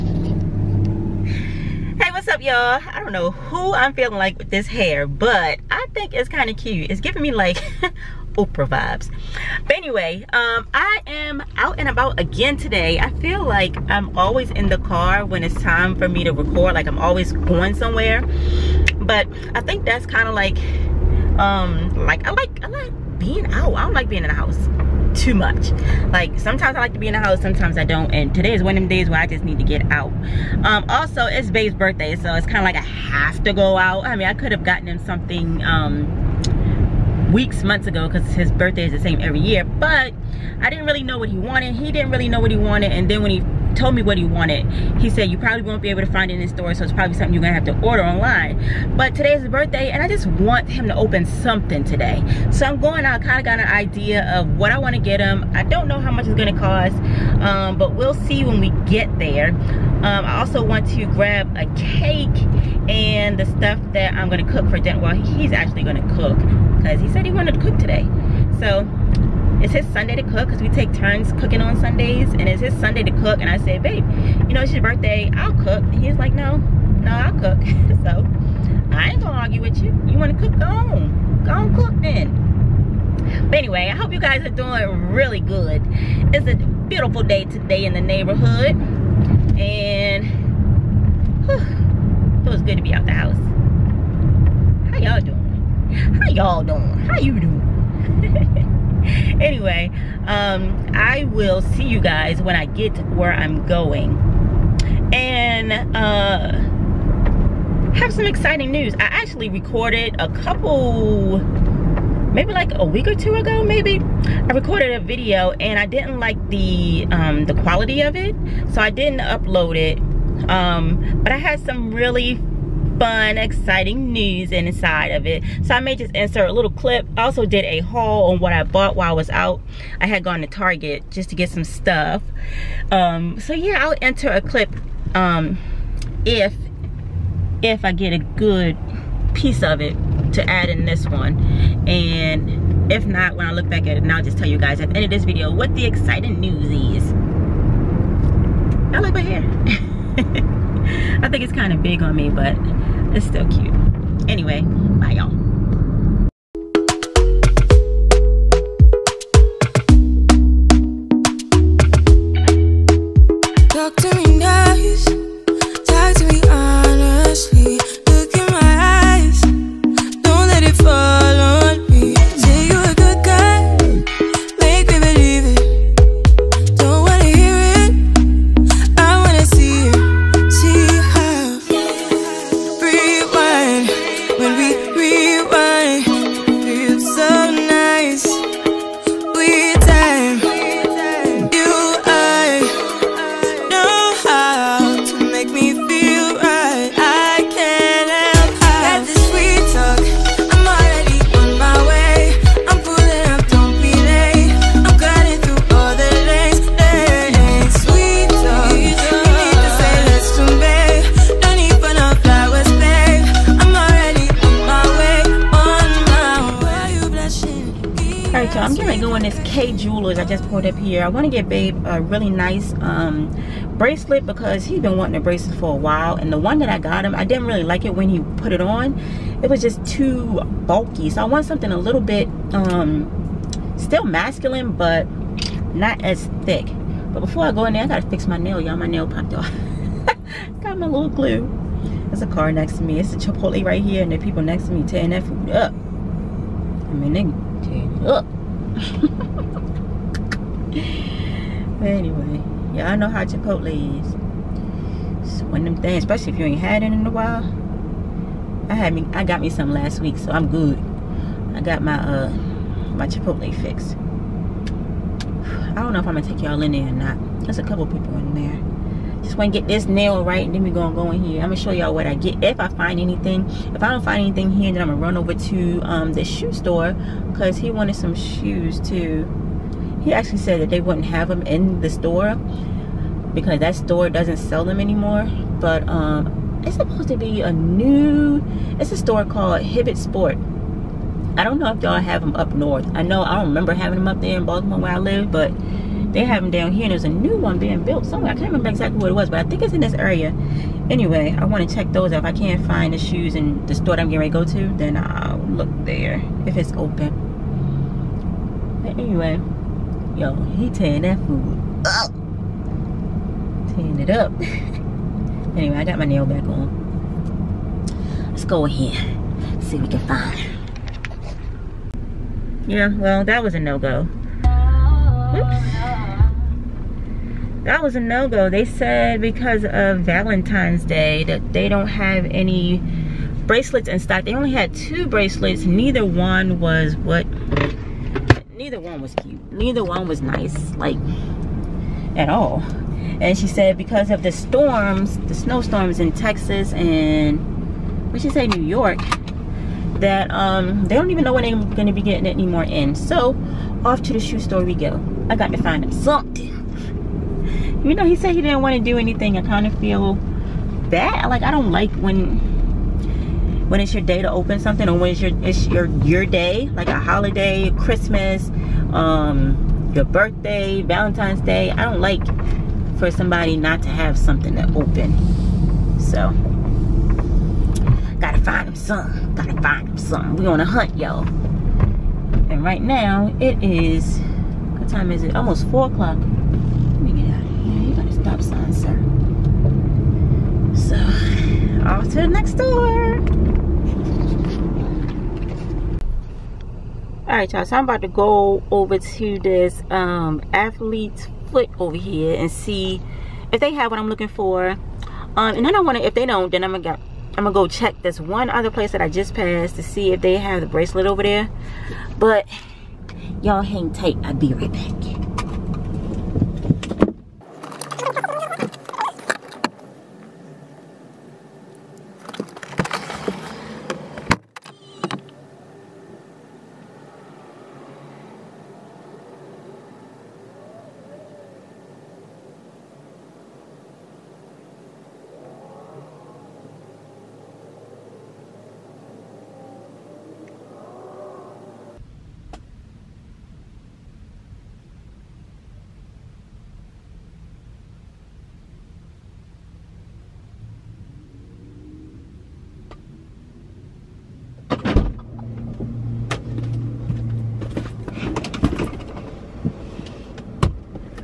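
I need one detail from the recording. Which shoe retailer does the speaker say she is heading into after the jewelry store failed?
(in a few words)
Athlete's Foot.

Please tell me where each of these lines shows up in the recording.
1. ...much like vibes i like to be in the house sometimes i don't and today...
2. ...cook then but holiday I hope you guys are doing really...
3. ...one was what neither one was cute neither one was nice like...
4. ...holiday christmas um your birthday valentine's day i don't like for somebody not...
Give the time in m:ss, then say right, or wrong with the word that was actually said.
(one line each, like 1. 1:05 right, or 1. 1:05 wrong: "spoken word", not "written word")
1. 0:25 wrong: "sometimes", not "vibes"
2. 1:21 wrong: "anyway", not "holiday"
3. 5:36 right
4. 6:06 right.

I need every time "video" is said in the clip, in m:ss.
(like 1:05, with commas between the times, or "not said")
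1:54, 2:25.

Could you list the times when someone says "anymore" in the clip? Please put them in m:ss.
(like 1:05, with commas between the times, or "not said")
4:44, 5:52.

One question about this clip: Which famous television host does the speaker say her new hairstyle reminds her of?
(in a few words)
Oprah.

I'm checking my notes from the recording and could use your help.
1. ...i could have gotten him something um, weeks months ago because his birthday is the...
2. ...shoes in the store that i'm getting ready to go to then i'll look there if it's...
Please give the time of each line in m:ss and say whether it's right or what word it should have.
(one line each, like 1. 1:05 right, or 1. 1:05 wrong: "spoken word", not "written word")
1. 0:34 right
2. 5:02 right.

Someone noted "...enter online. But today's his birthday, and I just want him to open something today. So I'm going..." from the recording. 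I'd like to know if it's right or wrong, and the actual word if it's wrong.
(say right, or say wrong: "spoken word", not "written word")
wrong: "order", not "enter".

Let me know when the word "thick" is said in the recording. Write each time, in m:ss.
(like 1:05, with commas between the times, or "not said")
3:56.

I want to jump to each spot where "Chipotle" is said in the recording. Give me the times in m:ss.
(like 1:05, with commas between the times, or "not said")
4:03, 4:13, 4:23.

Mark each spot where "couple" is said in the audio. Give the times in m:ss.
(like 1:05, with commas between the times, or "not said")
1:50, 4:27.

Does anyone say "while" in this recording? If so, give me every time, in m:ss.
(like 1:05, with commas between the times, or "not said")
2:08, 3:45, 4:17.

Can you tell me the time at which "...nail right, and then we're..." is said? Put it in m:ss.
4:29.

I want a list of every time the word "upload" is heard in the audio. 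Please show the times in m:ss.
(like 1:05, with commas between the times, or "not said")
1:59.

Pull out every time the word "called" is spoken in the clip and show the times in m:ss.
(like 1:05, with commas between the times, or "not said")
4:49.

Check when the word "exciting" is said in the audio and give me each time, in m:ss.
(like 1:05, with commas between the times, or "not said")
1:48, 2:03, 2:25.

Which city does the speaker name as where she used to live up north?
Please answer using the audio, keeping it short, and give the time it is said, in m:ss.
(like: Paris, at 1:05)
Baltimore, at 4:54.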